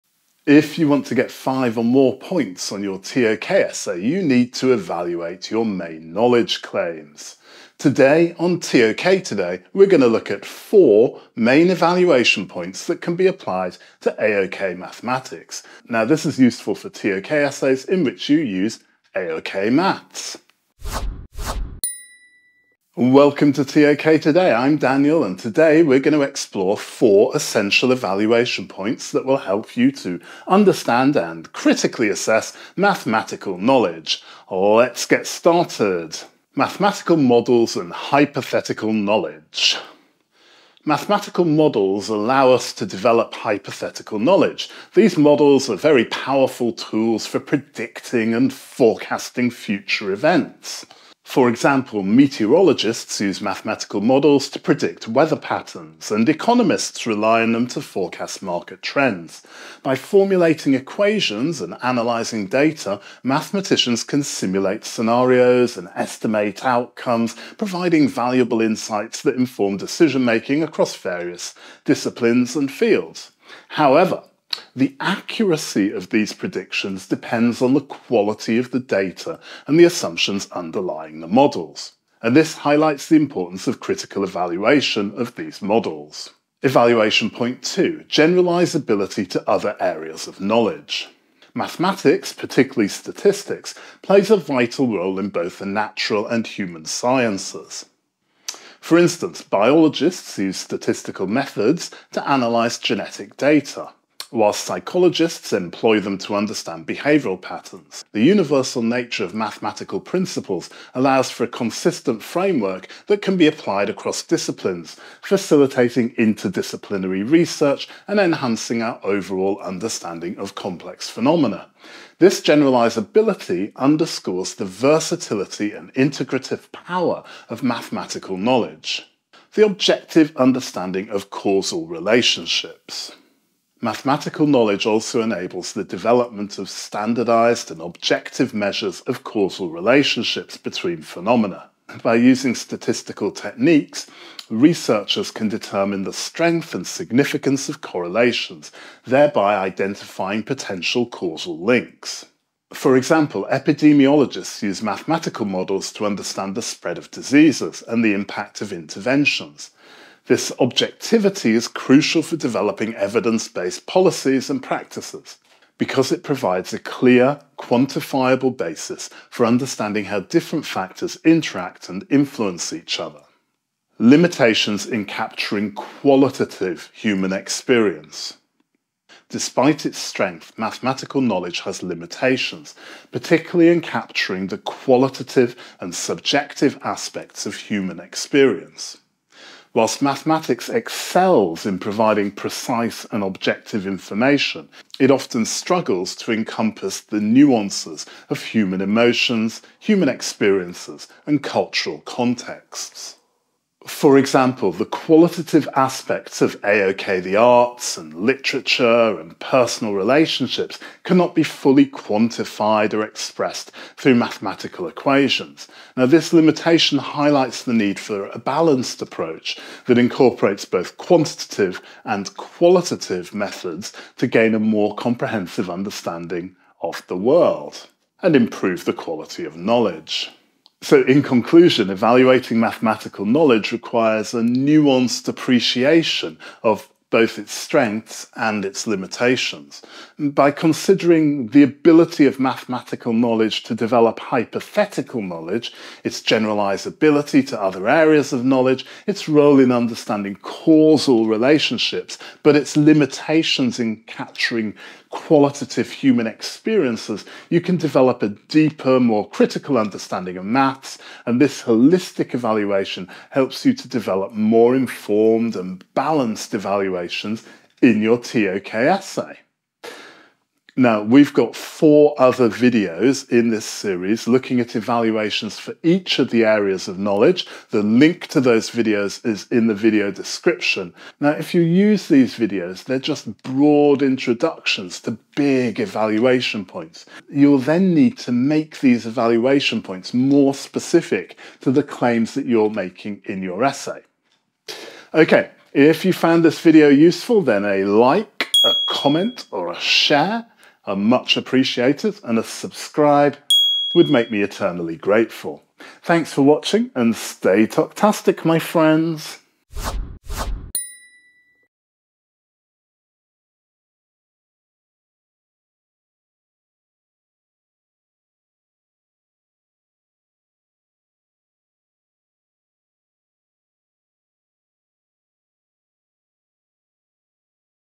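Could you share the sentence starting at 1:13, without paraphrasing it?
However, the accuracy of these predictions depends on the quality of the data and the assumptions underlying the models.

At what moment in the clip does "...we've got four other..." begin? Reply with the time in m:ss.
4:31.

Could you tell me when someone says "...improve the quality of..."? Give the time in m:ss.
3:48.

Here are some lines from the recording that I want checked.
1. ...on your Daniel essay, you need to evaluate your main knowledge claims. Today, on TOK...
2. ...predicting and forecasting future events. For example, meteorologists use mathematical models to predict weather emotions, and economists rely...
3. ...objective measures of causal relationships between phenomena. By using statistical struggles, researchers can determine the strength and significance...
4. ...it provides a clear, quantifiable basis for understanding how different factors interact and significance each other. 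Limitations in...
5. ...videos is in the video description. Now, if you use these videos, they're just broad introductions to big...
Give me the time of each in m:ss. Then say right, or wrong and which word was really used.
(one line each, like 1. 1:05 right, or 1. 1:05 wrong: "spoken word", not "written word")
1. 0:02 wrong: "TOK", not "Daniel"
2. 0:47 wrong: "patterns", not "emotions"
3. 2:17 wrong: "techniques", not "struggles"
4. 2:46 wrong: "influence", not "significance"
5. 4:38 right.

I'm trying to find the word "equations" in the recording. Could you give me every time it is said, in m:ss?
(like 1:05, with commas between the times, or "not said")
1:00, 3:34.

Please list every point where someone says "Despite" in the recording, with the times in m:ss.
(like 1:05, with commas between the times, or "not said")
2:59.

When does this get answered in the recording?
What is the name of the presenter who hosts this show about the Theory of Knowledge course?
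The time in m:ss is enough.
0:24.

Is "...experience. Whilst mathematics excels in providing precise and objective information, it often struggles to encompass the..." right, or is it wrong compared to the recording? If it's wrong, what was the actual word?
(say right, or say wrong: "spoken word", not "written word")
right.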